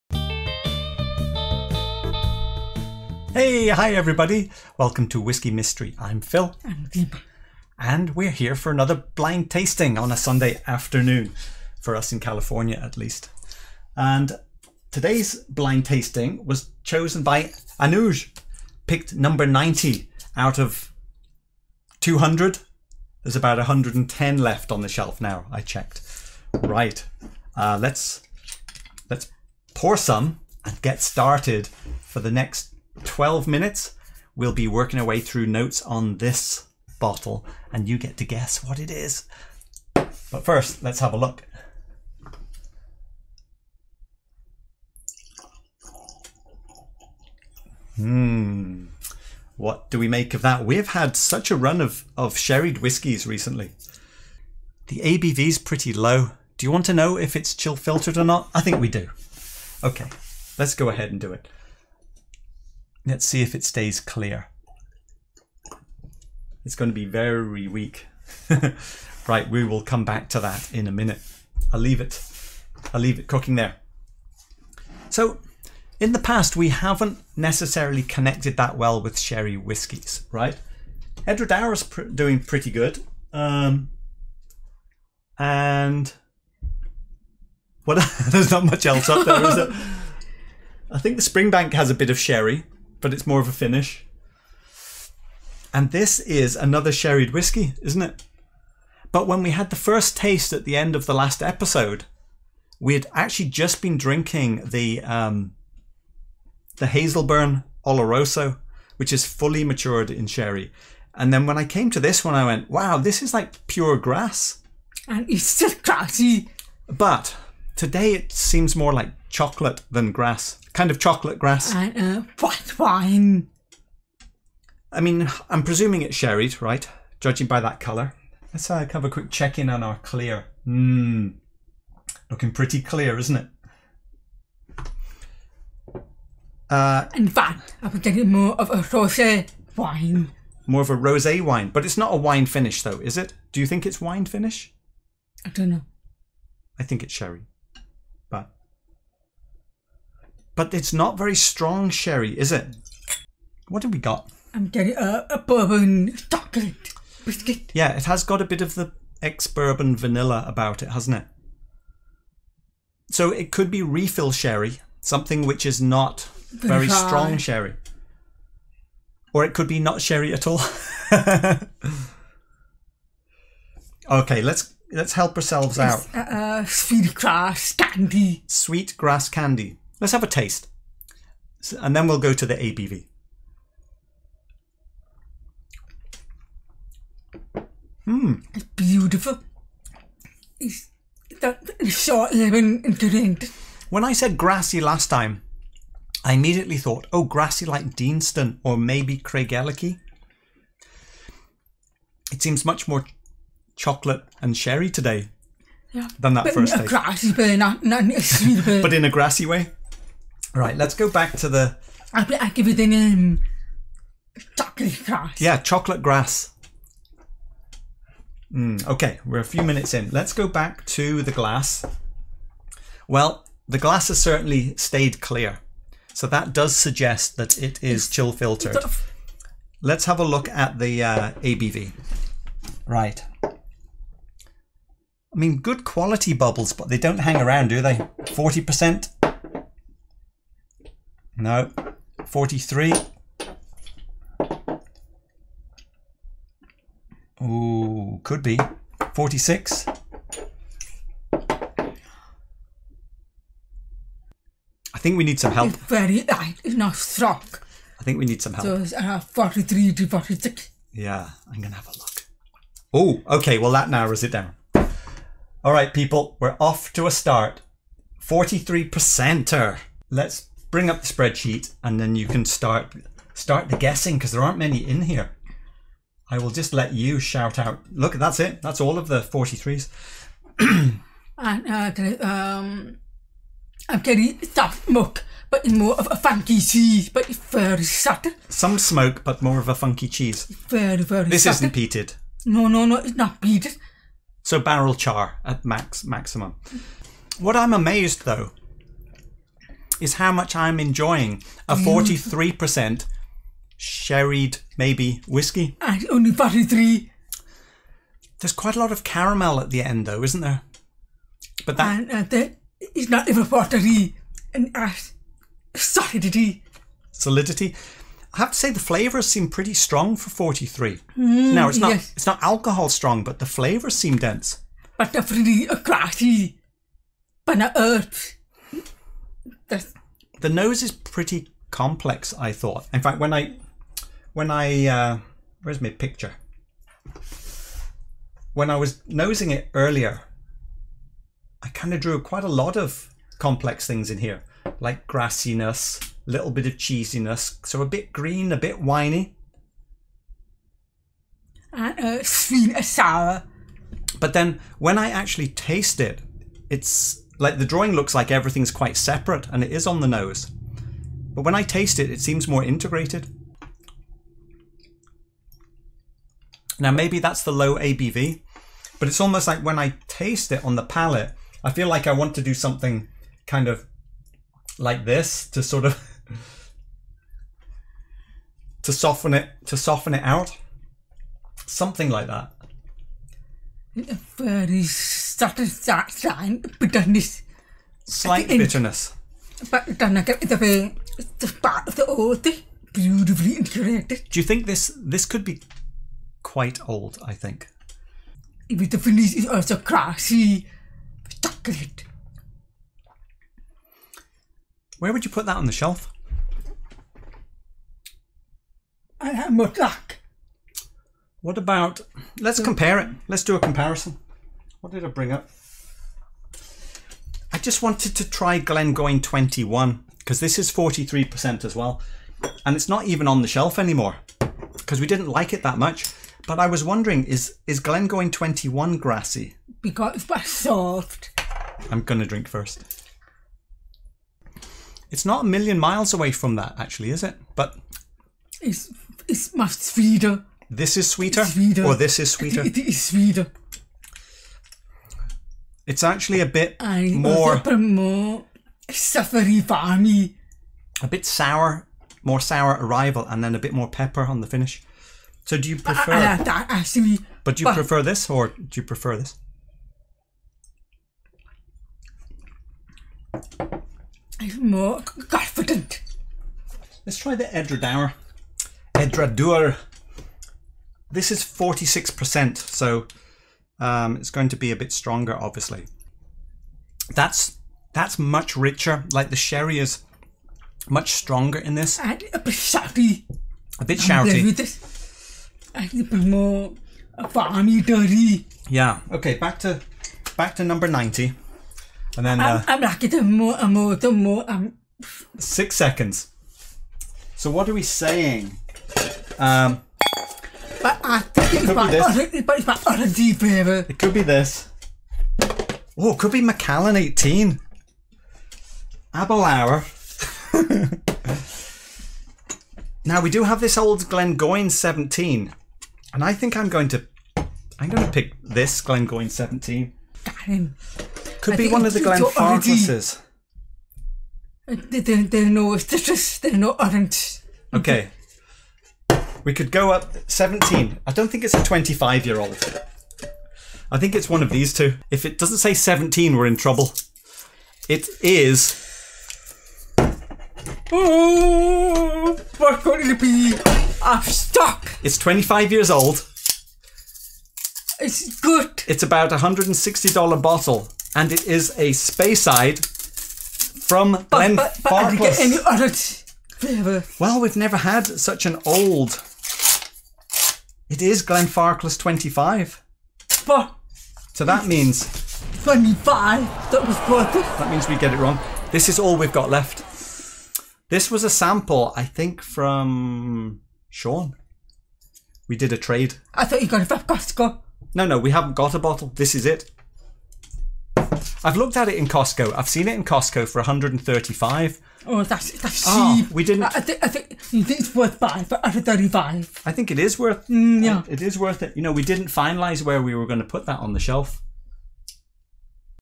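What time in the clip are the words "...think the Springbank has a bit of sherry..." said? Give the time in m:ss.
1:30.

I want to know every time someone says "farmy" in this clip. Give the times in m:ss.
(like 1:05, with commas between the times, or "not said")
7:29, 8:07.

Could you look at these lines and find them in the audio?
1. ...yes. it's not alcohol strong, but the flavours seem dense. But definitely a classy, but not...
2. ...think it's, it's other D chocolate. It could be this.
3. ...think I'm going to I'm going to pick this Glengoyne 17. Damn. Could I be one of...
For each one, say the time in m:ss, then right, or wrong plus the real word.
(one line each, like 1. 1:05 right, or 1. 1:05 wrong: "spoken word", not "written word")
1. 5:21 right
2. 8:22 wrong: "favourite", not "chocolate"
3. 8:36 right.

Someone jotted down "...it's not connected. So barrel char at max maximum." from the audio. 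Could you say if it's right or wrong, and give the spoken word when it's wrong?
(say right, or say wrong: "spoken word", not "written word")
wrong: "peated", not "connected".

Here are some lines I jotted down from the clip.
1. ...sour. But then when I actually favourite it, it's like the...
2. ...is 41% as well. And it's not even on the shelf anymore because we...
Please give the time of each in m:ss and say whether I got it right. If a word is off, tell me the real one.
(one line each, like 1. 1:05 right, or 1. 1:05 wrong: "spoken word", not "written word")
1. 5:52 wrong: "taste", not "favourite"
2. 7:00 wrong: "43", not "41".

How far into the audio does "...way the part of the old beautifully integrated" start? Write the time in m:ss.
6:30.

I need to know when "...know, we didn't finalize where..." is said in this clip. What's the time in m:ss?
9:51.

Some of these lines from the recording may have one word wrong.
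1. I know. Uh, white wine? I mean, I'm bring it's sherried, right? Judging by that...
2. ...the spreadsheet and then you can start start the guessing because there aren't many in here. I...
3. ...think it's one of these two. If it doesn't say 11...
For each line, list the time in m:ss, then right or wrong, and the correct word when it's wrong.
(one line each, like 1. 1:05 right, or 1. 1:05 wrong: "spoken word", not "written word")
1. 2:01 wrong: "presuming", not "bring"
2. 4:31 right
3. 8:53 wrong: "17", not "11".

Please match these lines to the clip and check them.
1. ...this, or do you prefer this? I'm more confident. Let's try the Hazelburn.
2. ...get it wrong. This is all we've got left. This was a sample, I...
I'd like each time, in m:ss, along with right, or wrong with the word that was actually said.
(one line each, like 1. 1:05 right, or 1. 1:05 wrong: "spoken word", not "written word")
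1. 7:38 wrong: "Edradour", not "Hazelburn"
2. 9:27 right.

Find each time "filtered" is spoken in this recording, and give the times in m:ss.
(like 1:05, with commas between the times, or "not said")
0:57, 3:48.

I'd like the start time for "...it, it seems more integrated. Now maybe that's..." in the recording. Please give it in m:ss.
6:01.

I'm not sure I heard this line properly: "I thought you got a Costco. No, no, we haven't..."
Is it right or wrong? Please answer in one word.
right.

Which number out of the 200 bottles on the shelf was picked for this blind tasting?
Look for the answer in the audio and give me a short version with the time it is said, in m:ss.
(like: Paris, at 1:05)
90, at 0:19.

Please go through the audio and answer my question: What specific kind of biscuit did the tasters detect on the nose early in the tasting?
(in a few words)
bourbon chocolate biscuit.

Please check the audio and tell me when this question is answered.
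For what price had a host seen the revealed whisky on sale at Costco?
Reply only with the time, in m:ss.
9:43.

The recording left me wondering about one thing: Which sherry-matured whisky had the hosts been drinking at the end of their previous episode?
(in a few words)
Hazelburn Oloroso.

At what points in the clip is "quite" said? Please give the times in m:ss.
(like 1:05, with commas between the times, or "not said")
5:08, 5:42, 5:58, 6:36.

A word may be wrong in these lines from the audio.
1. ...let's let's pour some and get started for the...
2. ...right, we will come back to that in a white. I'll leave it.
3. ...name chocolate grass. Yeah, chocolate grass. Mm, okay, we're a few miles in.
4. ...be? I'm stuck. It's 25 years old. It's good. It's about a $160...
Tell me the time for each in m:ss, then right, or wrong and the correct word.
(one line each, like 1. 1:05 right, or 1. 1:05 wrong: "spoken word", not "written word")
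1. 0:27 right
2. 1:09 wrong: "minute", not "white"
3. 3:32 wrong: "minutes", not "miles"
4. 9:03 right.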